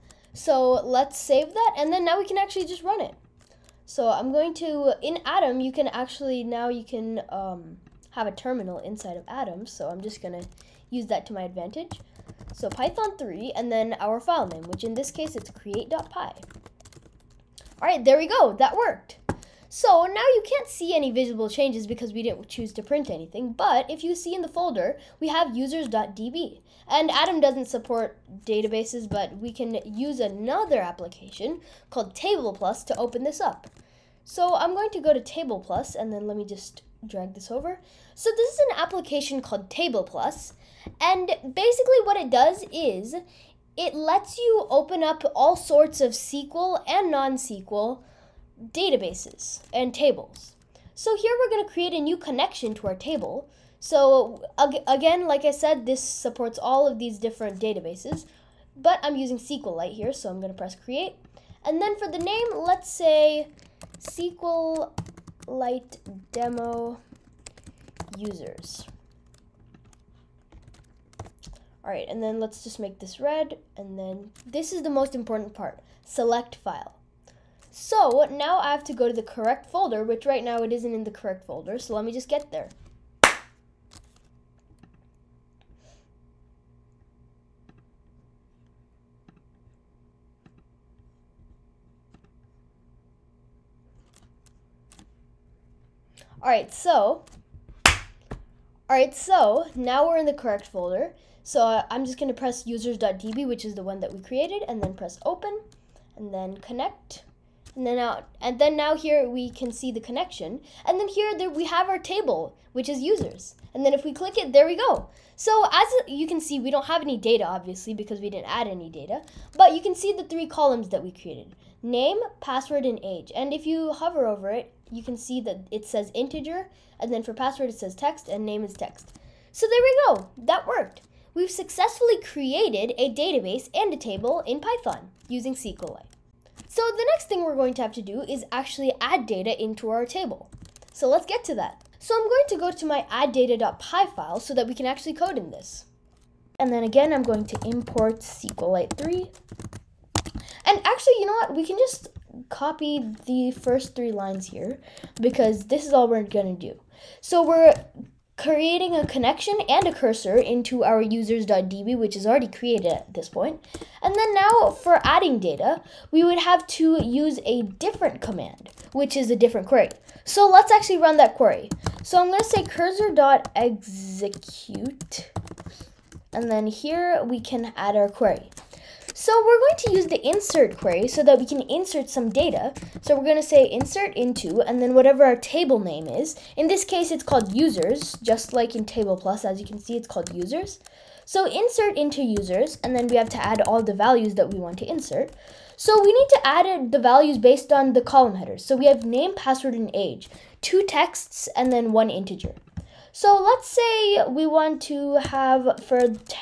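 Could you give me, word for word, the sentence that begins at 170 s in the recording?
So let's actually run that query.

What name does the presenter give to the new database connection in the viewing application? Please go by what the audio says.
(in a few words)
SQLite demo users.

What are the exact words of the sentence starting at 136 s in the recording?
So the next thing we're going to have to do is actually add data into our table.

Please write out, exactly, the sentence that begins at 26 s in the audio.
And Atom doesn't support databases, but we can use another application called Table Plus to open this up.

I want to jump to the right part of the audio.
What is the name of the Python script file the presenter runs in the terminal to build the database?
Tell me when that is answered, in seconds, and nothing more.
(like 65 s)
15 s.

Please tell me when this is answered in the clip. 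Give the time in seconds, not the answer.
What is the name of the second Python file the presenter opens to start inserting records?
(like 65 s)
143 s.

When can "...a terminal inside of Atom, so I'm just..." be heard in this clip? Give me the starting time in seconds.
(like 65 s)
8 s.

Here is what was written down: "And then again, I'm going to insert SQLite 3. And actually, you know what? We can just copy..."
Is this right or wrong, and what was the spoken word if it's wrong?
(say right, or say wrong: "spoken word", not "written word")
wrong: "import", not "insert".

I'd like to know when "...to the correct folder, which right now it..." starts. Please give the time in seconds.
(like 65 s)
79 s.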